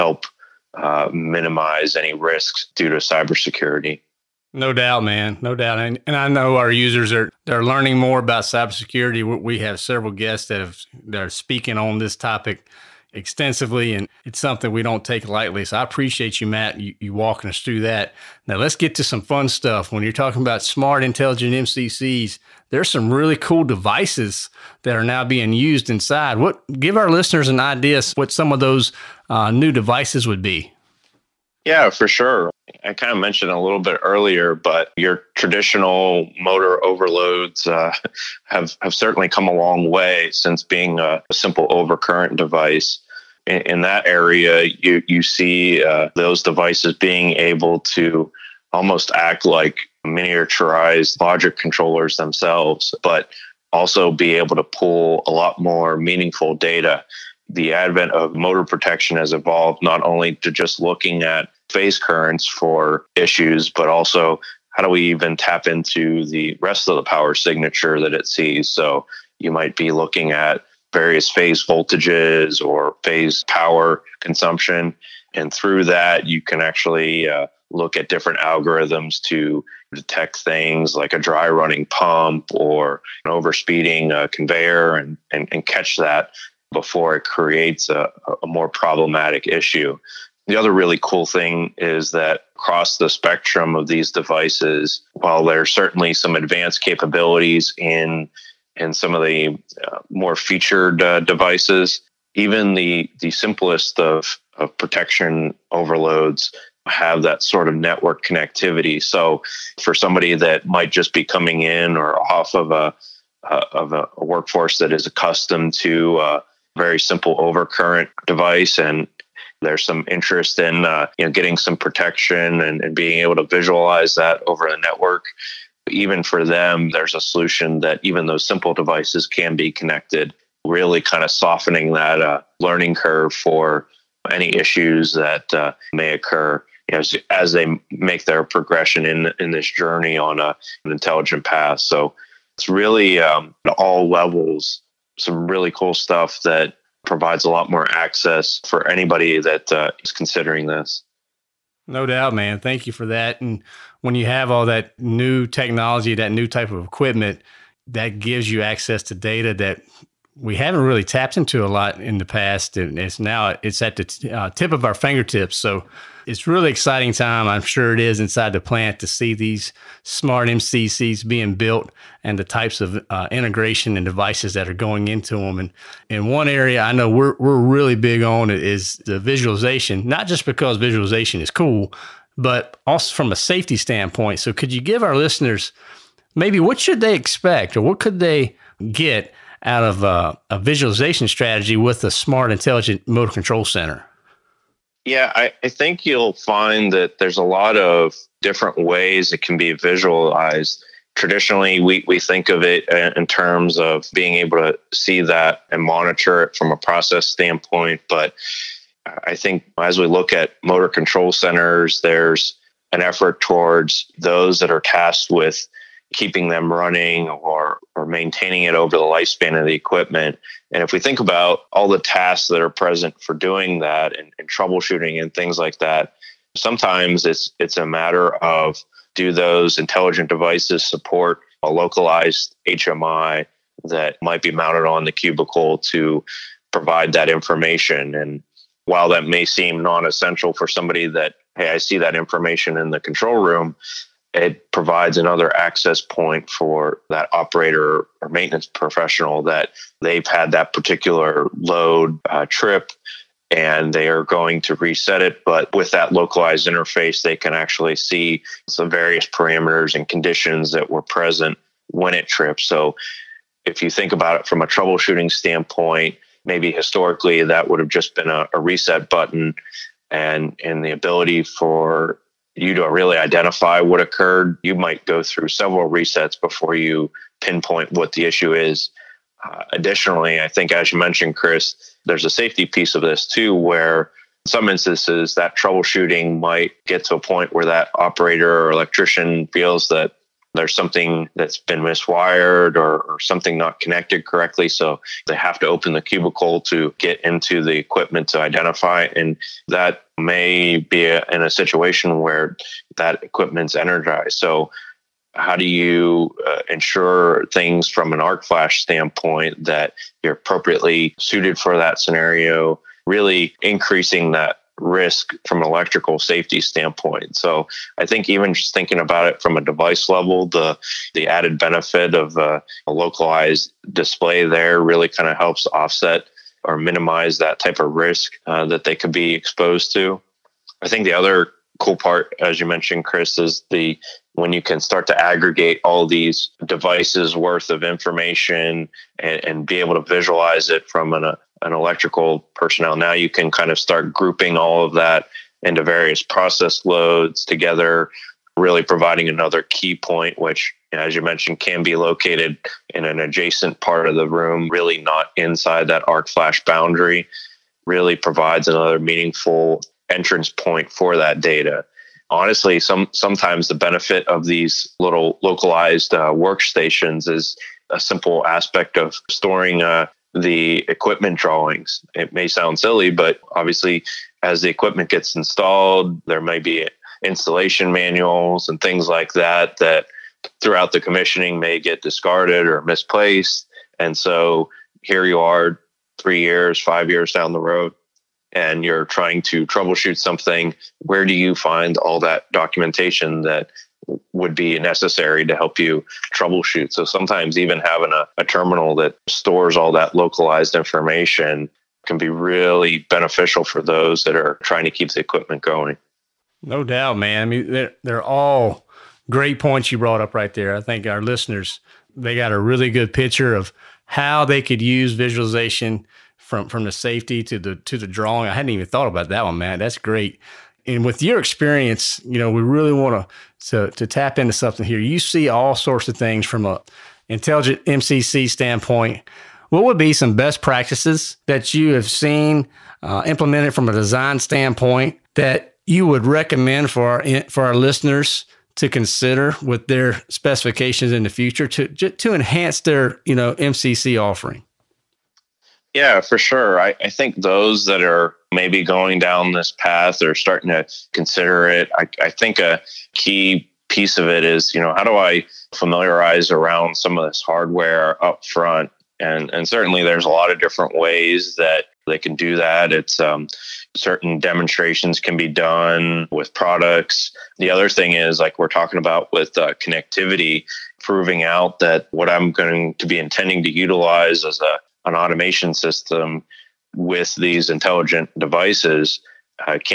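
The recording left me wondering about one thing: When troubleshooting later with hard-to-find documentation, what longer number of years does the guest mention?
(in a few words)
5 years.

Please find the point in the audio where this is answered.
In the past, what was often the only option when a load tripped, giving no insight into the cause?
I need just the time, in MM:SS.
04:28.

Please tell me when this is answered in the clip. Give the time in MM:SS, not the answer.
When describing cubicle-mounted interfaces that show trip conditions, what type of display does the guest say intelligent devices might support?
03:51.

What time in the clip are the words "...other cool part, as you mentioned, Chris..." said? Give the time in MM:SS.
05:31.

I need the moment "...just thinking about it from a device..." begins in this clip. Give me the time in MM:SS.
05:18.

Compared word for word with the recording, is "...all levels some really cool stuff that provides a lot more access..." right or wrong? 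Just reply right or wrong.
right.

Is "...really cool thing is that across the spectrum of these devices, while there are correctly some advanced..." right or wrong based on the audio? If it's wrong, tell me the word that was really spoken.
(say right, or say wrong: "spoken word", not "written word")
wrong: "certainly", not "correctly".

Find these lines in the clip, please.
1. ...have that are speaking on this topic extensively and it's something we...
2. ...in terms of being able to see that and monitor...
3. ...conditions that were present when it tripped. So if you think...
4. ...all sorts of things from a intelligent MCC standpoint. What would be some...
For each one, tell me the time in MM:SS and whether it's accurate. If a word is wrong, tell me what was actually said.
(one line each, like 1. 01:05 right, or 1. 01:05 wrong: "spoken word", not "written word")
1. 00:10 right
2. 03:23 right
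3. 04:20 right
4. 07:05 right.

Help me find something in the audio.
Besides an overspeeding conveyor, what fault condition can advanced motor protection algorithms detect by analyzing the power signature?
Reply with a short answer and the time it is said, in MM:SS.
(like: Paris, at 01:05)
dry running pump, at 01:21.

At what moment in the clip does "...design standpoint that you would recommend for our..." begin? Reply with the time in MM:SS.
07:13.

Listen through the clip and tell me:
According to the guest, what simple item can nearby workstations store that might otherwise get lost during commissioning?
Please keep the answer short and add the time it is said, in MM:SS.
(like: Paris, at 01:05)
equipment drawings, at 06:10.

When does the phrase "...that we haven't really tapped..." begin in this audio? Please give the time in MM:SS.
02:39.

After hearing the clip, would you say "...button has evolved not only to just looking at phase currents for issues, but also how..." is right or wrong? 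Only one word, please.
wrong.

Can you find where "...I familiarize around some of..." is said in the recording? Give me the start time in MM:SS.
07:35.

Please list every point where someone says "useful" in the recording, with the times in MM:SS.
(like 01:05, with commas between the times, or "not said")
not said.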